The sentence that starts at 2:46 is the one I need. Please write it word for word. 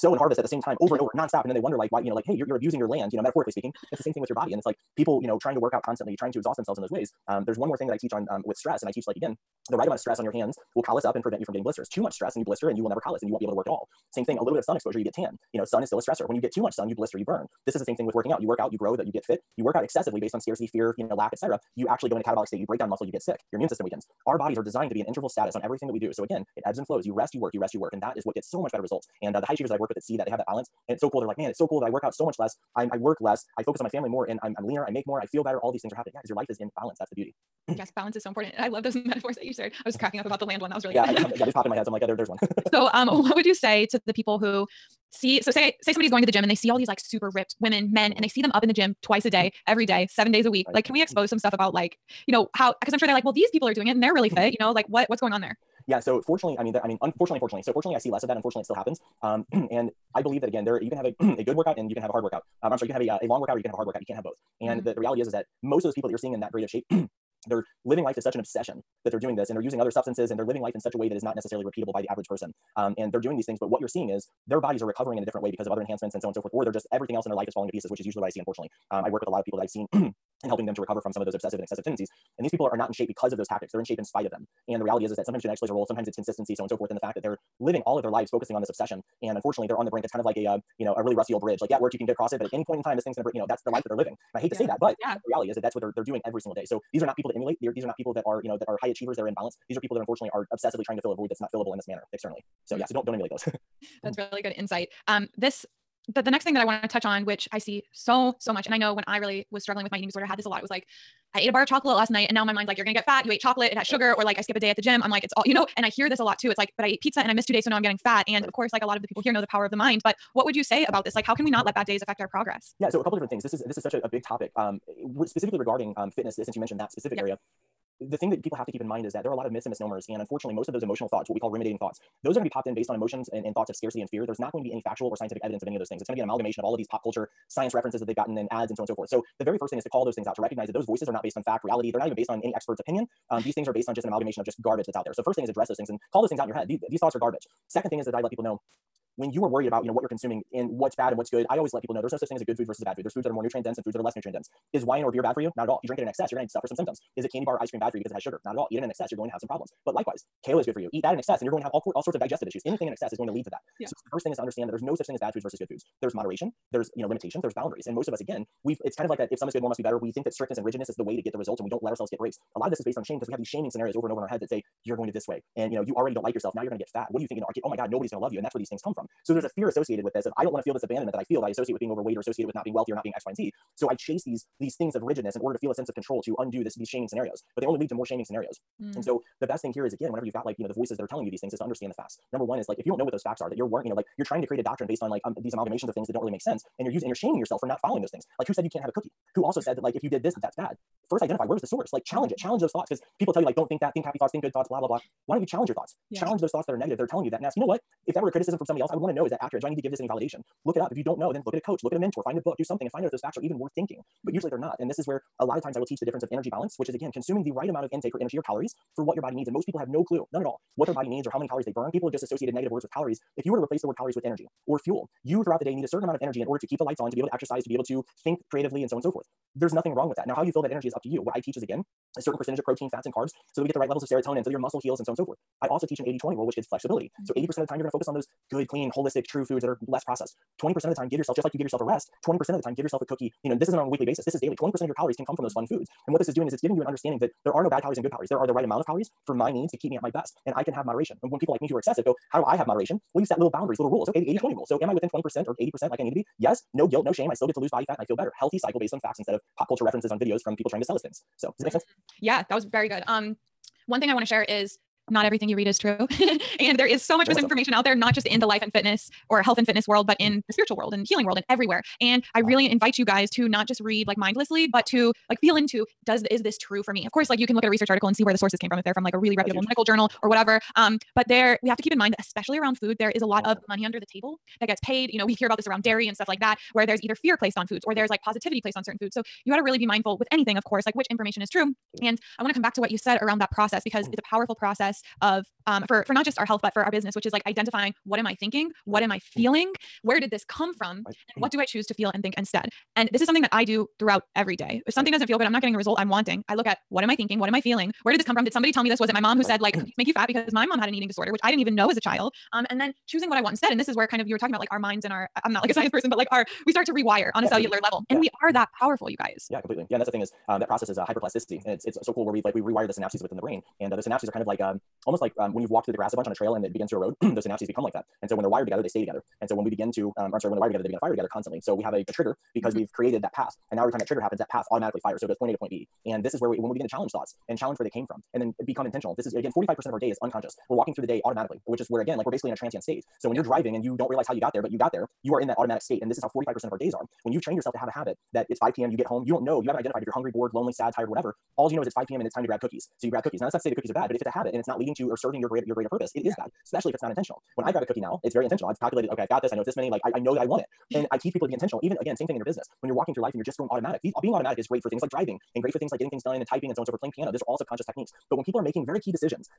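There's moderation, there's, you know, limitations, there's boundaries.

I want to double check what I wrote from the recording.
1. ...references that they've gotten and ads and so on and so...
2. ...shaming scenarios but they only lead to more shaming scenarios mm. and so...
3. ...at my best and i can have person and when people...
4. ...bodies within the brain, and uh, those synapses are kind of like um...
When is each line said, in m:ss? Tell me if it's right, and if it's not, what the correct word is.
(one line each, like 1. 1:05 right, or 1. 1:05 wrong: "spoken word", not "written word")
1. 2:17 right
2. 3:06 right
3. 4:09 wrong: "moderation", not "person"
4. 5:22 wrong: "synapses", not "bodies".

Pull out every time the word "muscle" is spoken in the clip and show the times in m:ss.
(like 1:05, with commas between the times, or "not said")
0:22, 3:54.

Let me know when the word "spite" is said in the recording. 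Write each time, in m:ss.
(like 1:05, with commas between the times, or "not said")
1:24.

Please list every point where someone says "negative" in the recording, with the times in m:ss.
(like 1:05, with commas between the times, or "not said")
3:26, 3:42.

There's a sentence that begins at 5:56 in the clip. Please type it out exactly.
bad, especially if it's not intentional.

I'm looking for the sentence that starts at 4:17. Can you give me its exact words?
I still get to lose body fat and I feel better.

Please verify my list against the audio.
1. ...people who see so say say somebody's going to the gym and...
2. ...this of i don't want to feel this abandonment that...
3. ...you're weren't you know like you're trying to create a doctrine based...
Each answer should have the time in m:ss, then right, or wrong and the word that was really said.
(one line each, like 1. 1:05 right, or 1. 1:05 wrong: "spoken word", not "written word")
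1. 0:44 right
2. 3:00 right
3. 3:13 right.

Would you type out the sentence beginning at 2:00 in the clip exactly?
But what would you say about this?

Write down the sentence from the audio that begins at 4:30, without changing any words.
in the spiritual world and healing world and everywhere.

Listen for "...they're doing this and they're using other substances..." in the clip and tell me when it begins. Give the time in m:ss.
1:09.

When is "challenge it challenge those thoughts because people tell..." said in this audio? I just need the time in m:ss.
3:22.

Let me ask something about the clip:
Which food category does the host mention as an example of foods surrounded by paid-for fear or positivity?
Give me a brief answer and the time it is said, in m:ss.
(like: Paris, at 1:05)
Dairy, at 4:45.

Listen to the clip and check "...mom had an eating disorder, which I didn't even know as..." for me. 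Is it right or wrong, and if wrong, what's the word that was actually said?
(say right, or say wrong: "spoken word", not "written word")
right.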